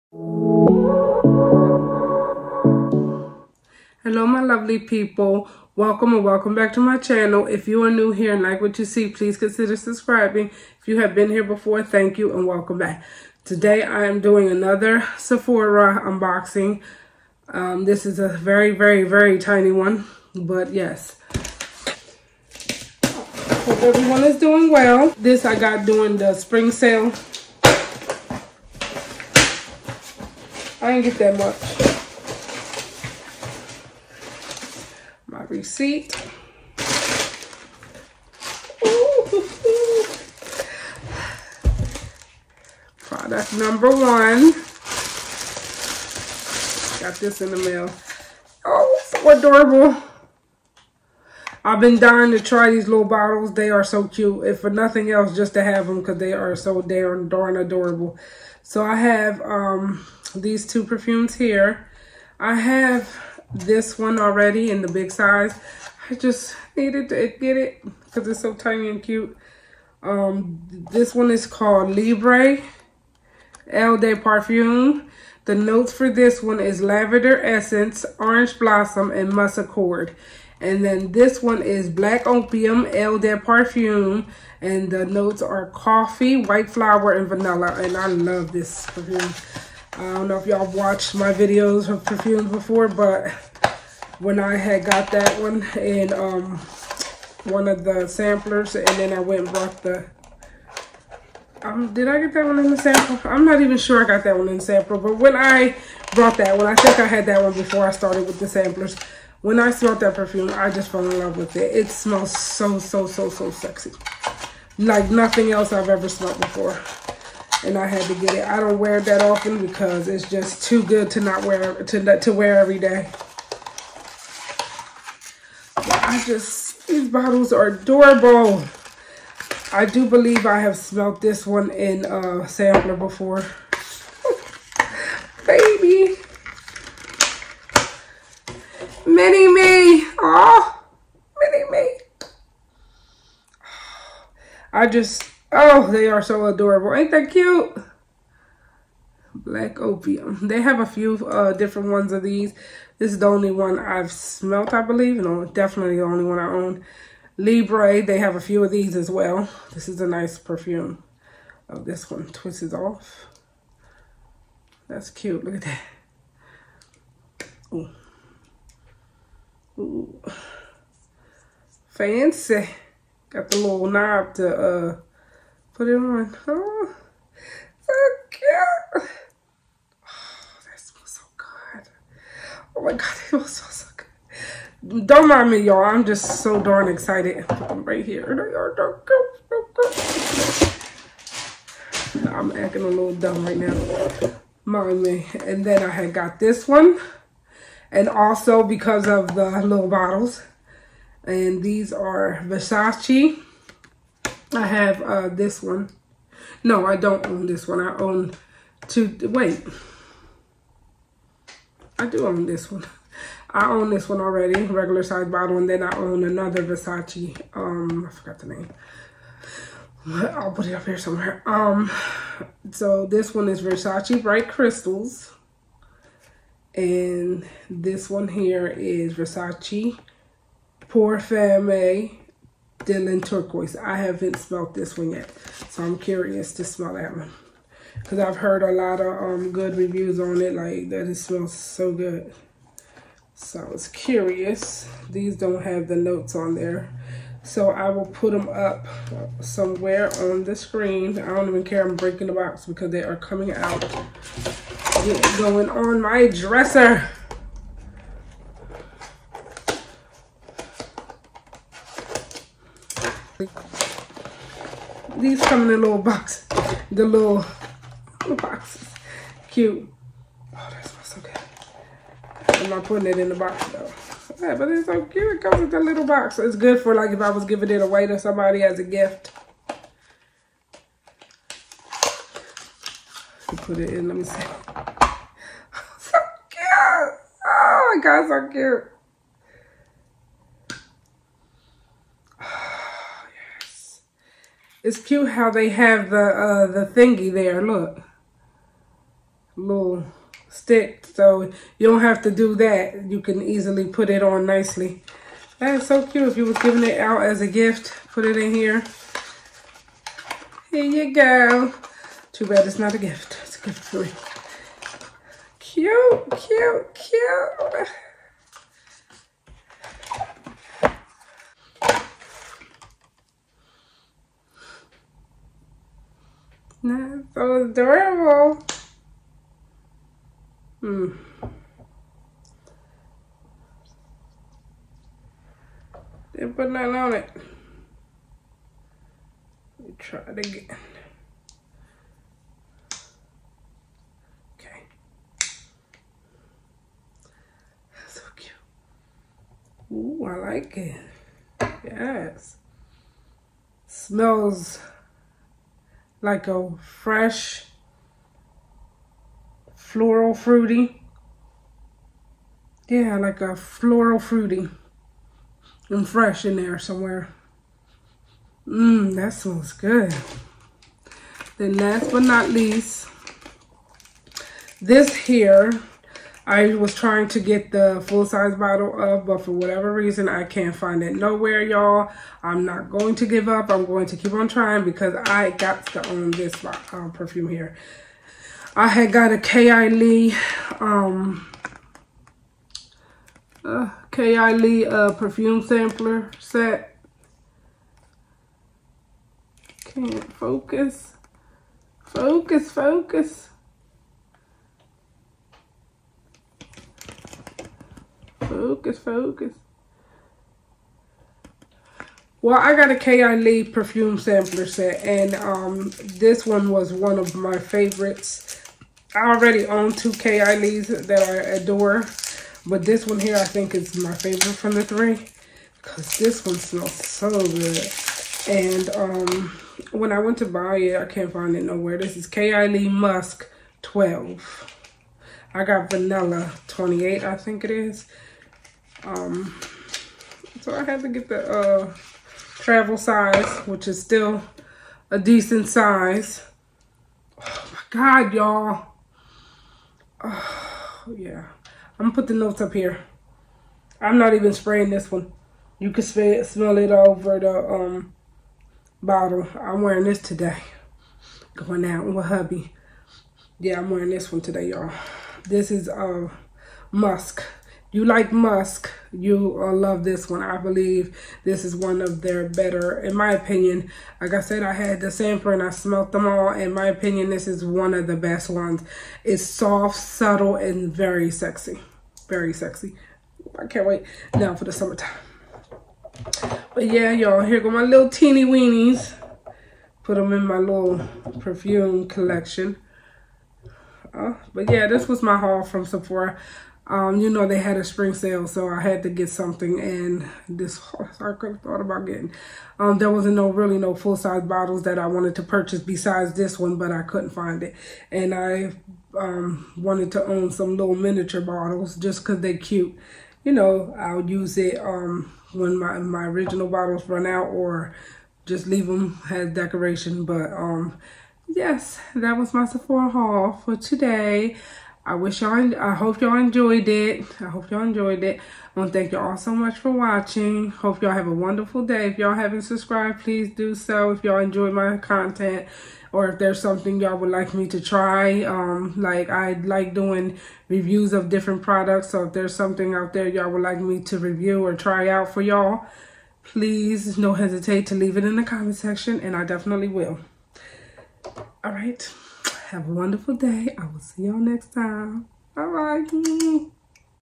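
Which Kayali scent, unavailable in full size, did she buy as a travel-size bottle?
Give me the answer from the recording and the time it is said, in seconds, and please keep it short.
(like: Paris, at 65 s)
Kayali Musk 12, at 432 s.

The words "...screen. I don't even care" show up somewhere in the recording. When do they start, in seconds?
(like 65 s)
250 s.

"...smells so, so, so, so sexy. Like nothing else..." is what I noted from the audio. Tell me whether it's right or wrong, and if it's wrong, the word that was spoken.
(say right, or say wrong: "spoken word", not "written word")
right.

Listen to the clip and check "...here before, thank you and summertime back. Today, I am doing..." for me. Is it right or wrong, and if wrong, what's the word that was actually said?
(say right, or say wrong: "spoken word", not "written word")
wrong: "welcome", not "summertime".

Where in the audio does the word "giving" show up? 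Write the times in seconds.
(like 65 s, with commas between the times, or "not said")
277 s, 306 s.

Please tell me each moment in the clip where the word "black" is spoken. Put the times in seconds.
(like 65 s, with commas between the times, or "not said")
81 s, 149 s.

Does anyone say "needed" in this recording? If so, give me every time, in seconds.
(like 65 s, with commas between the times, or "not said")
66 s.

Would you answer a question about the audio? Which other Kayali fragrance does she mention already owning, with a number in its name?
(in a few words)
Vanilla 28.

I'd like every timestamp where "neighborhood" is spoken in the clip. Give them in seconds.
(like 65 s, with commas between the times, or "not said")
not said.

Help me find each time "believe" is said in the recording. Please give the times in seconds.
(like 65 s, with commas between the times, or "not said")
130 s, 154 s, 470 s.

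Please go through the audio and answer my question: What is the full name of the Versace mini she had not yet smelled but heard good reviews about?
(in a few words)
Versace Pour Femme Dylan Turquoise.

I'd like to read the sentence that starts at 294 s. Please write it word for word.
It's cute how they have the uh, the thingy there.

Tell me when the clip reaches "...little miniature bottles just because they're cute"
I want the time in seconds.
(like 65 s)
510 s.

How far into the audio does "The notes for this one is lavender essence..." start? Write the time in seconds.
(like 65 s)
75 s.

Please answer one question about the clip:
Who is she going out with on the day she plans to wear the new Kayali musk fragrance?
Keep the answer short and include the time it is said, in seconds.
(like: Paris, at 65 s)
hubby, at 462 s.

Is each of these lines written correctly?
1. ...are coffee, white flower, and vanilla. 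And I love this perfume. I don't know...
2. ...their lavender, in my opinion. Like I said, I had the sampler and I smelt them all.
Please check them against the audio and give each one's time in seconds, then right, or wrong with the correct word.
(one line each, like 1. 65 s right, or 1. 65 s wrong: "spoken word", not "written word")
1. 85 s right
2. 472 s wrong: "better", not "lavender".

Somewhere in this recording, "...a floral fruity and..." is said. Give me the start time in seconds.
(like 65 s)
363 s.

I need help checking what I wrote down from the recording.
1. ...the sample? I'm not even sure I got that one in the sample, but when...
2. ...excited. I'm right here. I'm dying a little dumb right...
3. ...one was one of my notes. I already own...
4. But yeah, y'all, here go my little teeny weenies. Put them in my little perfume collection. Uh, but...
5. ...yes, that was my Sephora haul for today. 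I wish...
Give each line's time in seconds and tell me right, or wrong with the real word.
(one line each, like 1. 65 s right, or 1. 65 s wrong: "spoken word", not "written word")
1. 102 s right
2. 186 s wrong: "acting", not "dying"
3. 416 s wrong: "favorites", not "notes"
4. 486 s right
5. 521 s right.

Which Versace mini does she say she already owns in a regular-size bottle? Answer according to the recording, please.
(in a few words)
Bright Crystals.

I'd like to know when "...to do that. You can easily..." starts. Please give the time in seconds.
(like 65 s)
302 s.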